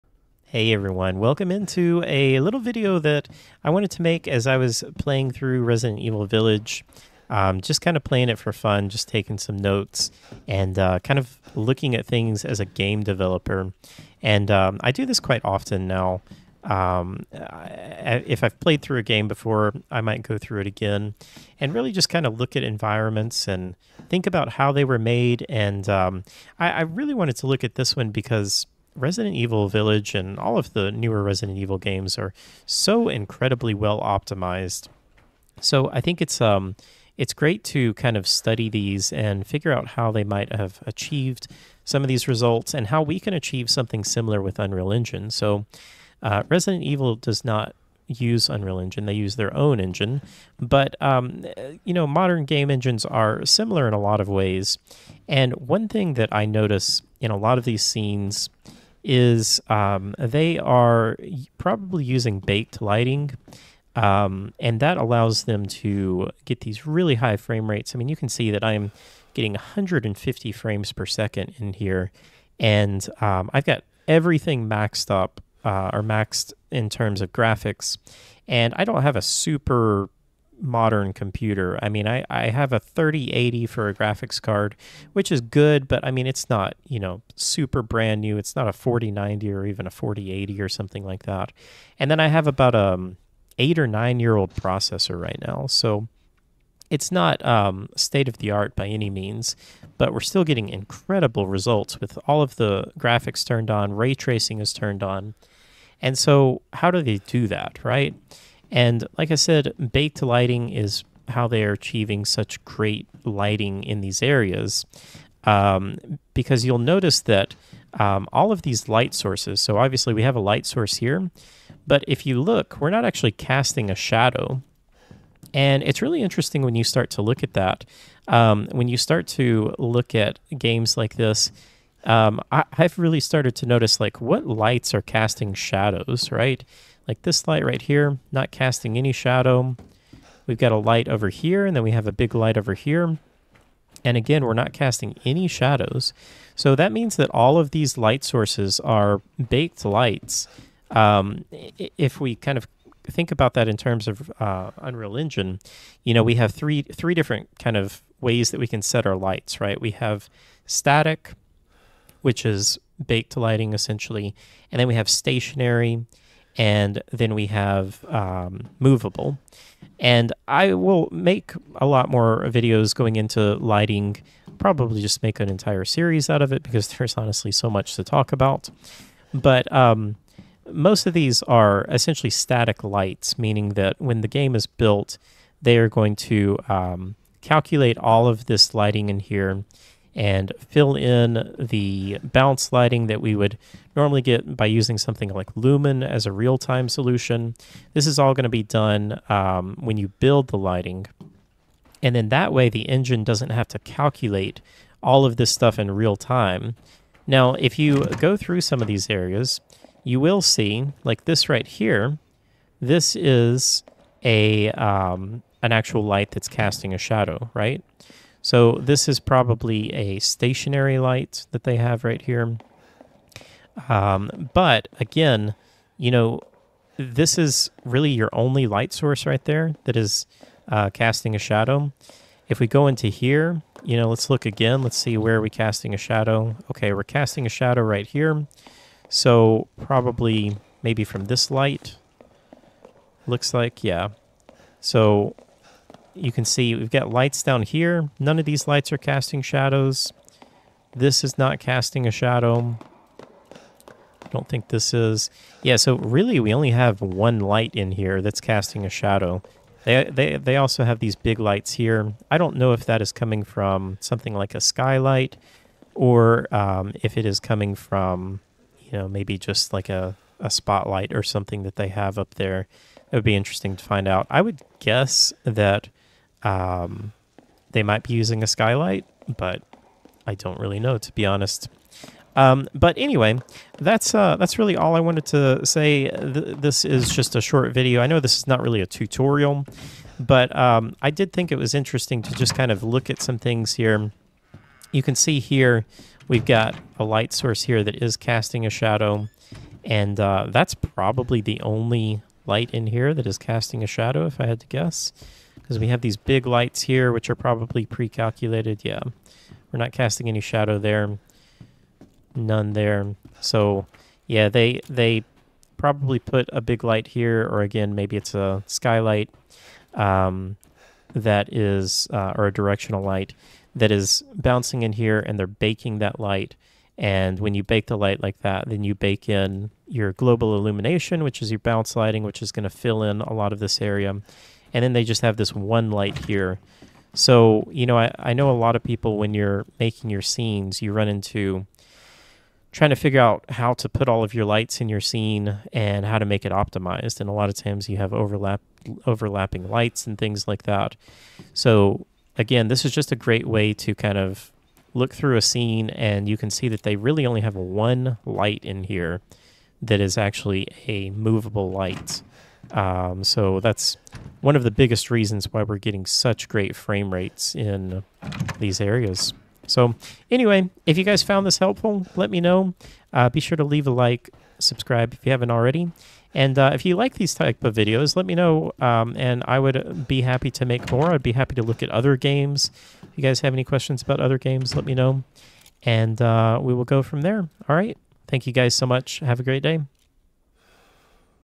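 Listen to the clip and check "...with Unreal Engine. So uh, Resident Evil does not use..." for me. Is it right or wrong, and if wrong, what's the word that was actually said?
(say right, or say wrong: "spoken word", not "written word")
right.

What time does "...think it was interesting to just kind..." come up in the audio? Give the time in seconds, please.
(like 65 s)
291 s.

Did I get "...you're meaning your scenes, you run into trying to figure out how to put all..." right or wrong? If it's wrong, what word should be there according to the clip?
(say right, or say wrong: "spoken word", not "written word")
wrong: "making", not "meaning".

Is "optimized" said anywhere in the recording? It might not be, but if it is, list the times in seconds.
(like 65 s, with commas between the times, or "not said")
34 s, 346 s.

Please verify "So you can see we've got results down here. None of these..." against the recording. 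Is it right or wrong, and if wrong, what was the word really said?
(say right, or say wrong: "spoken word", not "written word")
wrong: "lights", not "results".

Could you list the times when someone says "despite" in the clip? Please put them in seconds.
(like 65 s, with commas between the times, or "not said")
not said.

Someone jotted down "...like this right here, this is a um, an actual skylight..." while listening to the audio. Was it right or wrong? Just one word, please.
wrong.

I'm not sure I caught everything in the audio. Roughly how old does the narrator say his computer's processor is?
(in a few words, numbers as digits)
8 or 9 years.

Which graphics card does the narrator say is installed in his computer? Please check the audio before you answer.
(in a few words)
3080.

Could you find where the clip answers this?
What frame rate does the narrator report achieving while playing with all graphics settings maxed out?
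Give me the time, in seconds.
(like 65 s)
69 s.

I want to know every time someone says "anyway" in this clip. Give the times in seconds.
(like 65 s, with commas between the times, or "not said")
282 s, 370 s.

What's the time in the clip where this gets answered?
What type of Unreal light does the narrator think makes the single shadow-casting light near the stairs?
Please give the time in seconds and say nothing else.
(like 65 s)
220 s.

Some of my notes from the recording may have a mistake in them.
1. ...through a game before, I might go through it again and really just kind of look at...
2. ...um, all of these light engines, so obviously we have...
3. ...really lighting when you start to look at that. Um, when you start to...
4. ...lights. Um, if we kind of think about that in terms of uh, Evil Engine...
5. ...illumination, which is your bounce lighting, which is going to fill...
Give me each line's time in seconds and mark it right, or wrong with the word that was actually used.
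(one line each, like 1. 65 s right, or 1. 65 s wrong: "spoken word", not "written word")
1. 18 s right
2. 117 s wrong: "sources", not "engines"
3. 126 s wrong: "interesting", not "lighting"
4. 149 s wrong: "Unreal", not "Evil"
5. 330 s right.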